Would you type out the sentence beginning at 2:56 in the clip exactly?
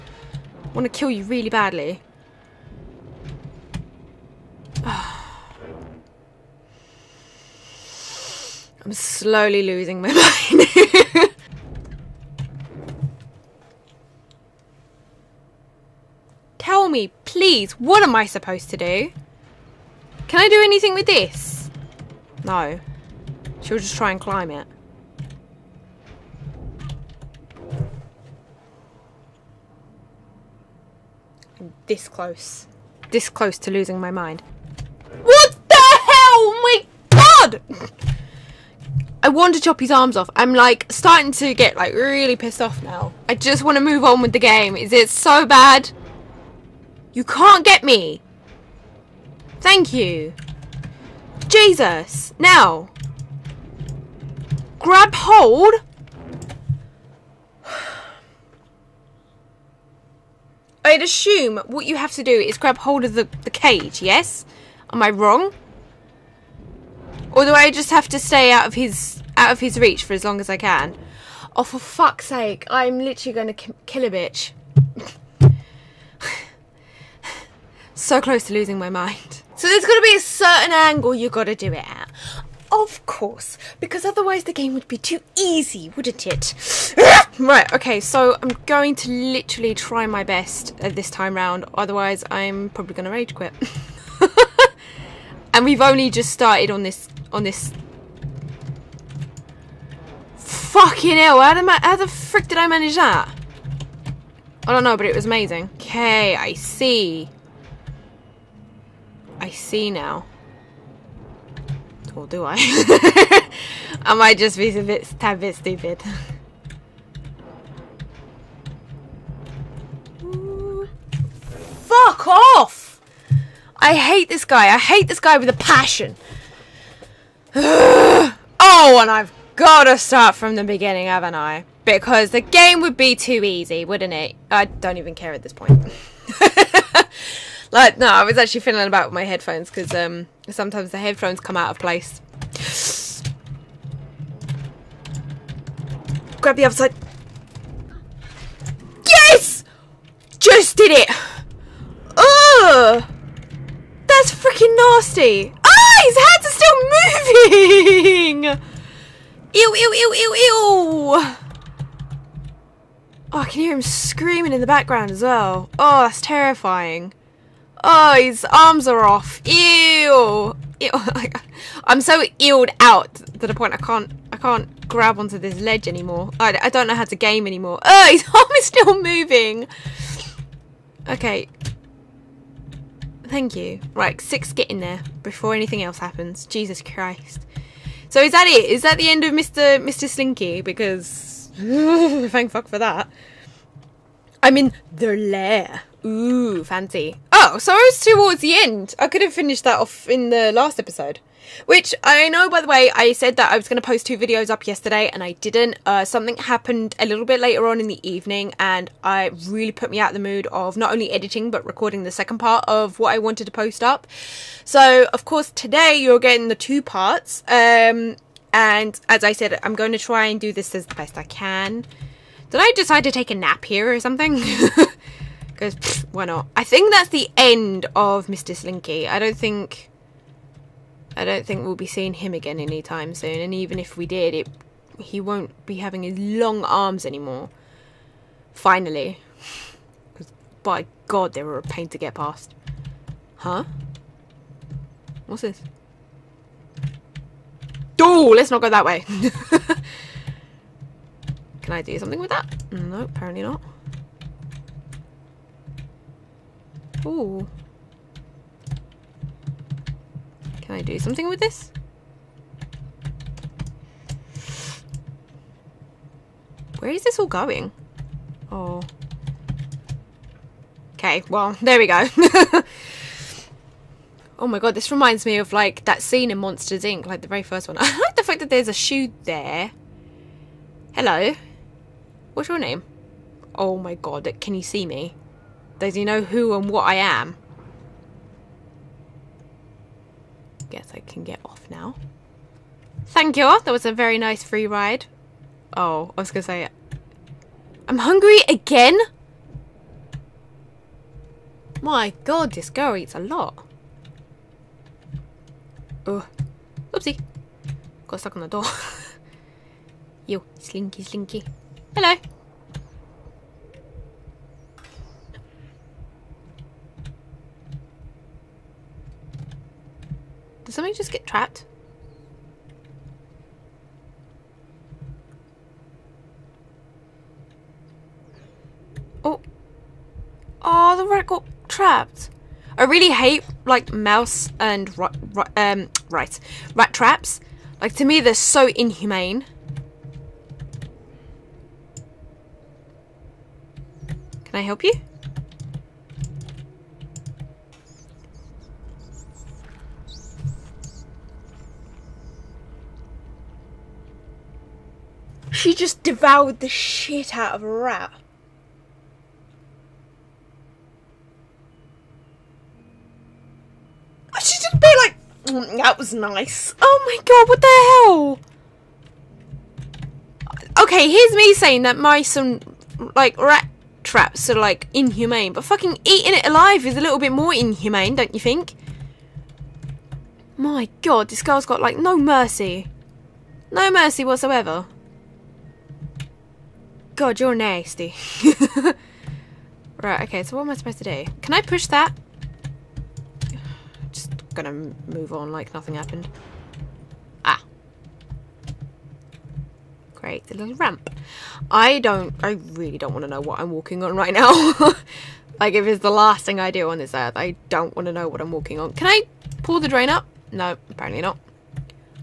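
I, I don't know how to game anymore.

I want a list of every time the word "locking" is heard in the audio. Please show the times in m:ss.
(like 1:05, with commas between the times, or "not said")
not said.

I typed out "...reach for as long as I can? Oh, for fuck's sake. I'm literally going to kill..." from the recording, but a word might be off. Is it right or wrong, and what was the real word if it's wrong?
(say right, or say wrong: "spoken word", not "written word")
right.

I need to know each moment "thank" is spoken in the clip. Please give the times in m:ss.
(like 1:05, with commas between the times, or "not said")
0:49, 3:03, 3:11, 4:53.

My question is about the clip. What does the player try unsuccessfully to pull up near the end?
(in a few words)
the drain.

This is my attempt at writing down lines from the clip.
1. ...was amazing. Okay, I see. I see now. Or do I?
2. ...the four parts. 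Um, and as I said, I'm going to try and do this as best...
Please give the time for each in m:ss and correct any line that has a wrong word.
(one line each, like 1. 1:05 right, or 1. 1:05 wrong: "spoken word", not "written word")
1. 1:45 right
2. 3:36 wrong: "two", not "four".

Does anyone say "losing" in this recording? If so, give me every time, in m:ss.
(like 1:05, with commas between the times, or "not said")
0:09, 0:33, 1:18.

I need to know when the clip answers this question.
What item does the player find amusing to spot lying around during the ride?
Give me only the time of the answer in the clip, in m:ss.
4:38.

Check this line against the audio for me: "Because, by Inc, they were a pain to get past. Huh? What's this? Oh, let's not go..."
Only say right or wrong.
wrong.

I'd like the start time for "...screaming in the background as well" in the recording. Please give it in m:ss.
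2:43.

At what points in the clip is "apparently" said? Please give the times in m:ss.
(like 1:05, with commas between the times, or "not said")
4:13, 6:50.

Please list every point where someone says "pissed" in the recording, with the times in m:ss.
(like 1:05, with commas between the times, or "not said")
0:42.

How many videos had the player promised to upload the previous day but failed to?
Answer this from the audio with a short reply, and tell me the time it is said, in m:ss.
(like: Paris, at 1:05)
2, at 3:24.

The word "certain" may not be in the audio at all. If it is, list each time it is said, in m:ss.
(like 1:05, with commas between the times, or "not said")
1:20.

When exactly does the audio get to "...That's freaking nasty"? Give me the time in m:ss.
2:34.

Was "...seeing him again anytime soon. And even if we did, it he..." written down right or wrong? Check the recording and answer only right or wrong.
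right.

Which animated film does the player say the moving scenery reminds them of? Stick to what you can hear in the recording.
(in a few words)
Monsters Inc.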